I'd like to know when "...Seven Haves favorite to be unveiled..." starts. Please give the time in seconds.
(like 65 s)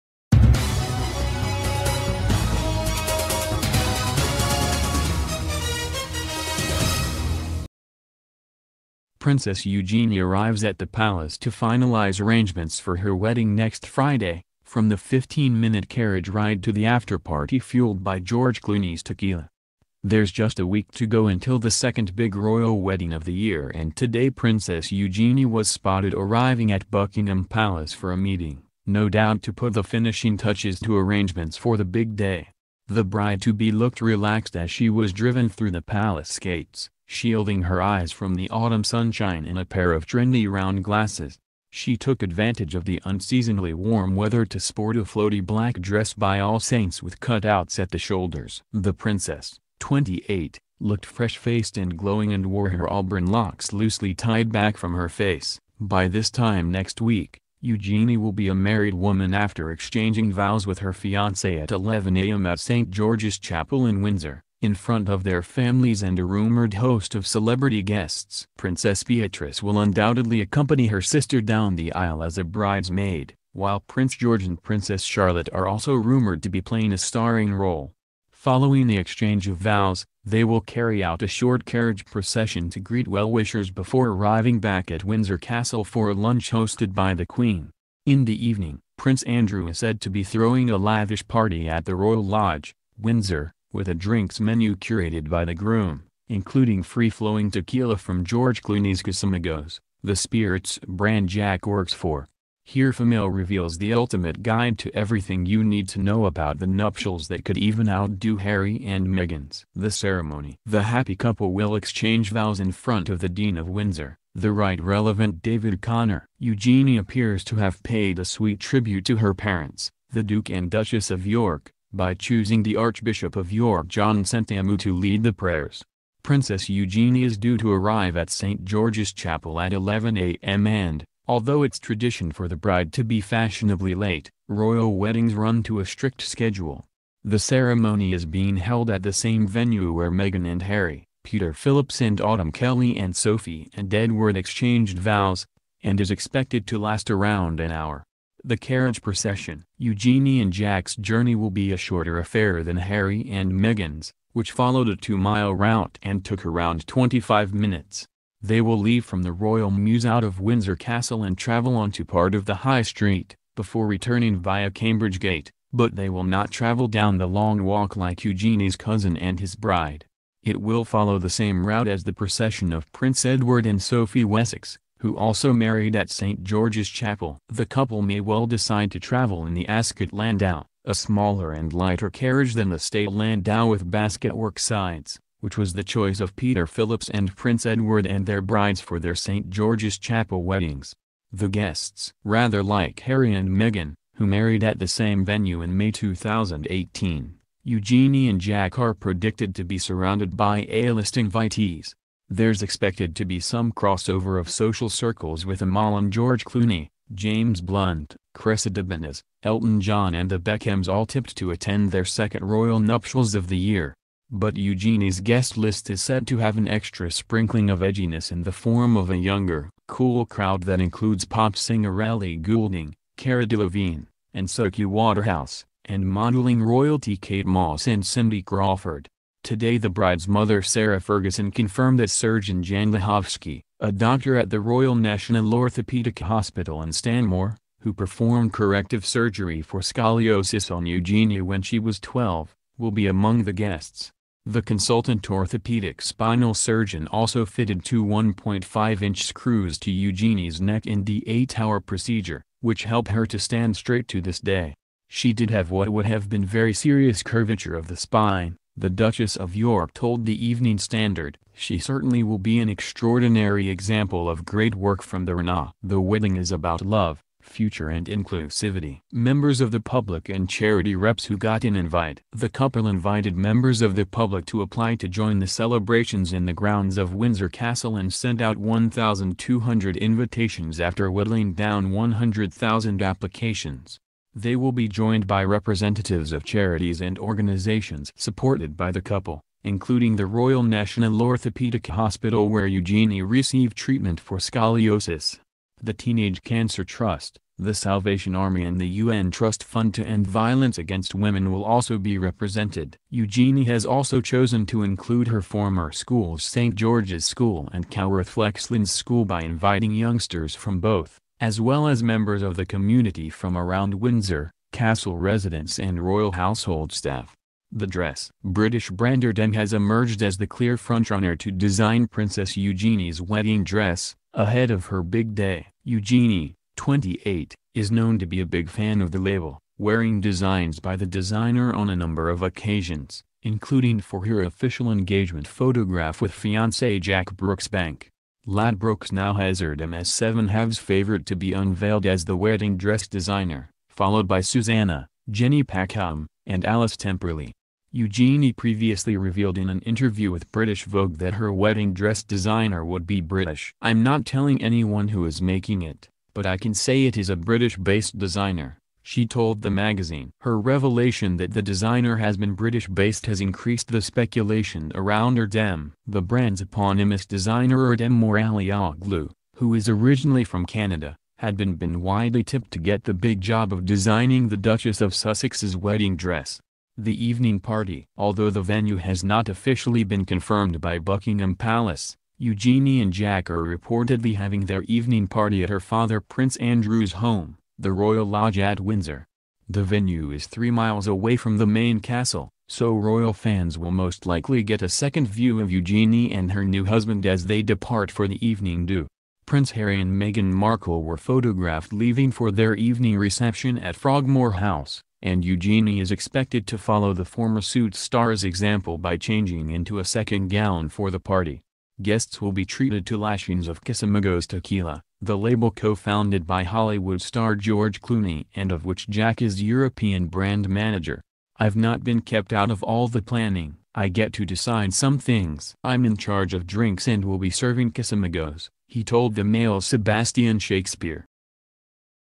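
340 s.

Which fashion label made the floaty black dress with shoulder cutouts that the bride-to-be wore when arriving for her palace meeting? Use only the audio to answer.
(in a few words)
All Saints.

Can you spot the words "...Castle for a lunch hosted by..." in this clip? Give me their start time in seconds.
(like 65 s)
85 s.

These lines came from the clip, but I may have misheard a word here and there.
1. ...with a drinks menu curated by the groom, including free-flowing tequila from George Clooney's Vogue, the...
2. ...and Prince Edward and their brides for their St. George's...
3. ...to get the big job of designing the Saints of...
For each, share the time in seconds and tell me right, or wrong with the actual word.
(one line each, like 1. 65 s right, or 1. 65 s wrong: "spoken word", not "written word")
1. 93 s wrong: "Casamigos", not "Vogue"
2. 187 s right
3. 372 s wrong: "Duchess", not "Saints".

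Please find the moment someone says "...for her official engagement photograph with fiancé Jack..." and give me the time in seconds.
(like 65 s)
333 s.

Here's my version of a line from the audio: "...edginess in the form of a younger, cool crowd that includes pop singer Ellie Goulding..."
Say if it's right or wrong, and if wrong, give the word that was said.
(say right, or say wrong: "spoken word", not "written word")
right.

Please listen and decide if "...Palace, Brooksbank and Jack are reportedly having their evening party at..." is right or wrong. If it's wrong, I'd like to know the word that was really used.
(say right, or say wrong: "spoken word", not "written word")
wrong: "Eugenie", not "Brooksbank".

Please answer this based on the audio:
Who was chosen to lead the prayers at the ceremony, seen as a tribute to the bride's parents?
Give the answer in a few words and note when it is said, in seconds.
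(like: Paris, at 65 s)
John Sentamu, at 123 s.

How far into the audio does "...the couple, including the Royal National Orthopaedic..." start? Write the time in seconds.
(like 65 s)
288 s.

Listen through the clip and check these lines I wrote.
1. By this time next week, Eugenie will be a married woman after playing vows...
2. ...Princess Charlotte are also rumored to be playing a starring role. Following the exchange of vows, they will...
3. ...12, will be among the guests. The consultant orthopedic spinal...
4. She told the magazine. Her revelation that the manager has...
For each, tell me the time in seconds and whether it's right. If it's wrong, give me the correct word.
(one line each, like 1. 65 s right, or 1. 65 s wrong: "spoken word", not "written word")
1. 55 s wrong: "exchanging", not "playing"
2. 74 s right
3. 241 s right
4. 359 s wrong: "designer", not "manager".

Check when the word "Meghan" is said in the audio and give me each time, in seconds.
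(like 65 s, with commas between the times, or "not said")
109 s, 140 s, 153 s, 193 s, 400 s.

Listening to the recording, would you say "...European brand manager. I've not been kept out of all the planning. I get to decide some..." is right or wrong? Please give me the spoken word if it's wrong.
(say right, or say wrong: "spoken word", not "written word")
right.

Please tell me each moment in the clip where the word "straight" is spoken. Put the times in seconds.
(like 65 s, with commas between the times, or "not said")
253 s.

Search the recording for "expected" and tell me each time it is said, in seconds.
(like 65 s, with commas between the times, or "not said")
146 s, 202 s, 406 s.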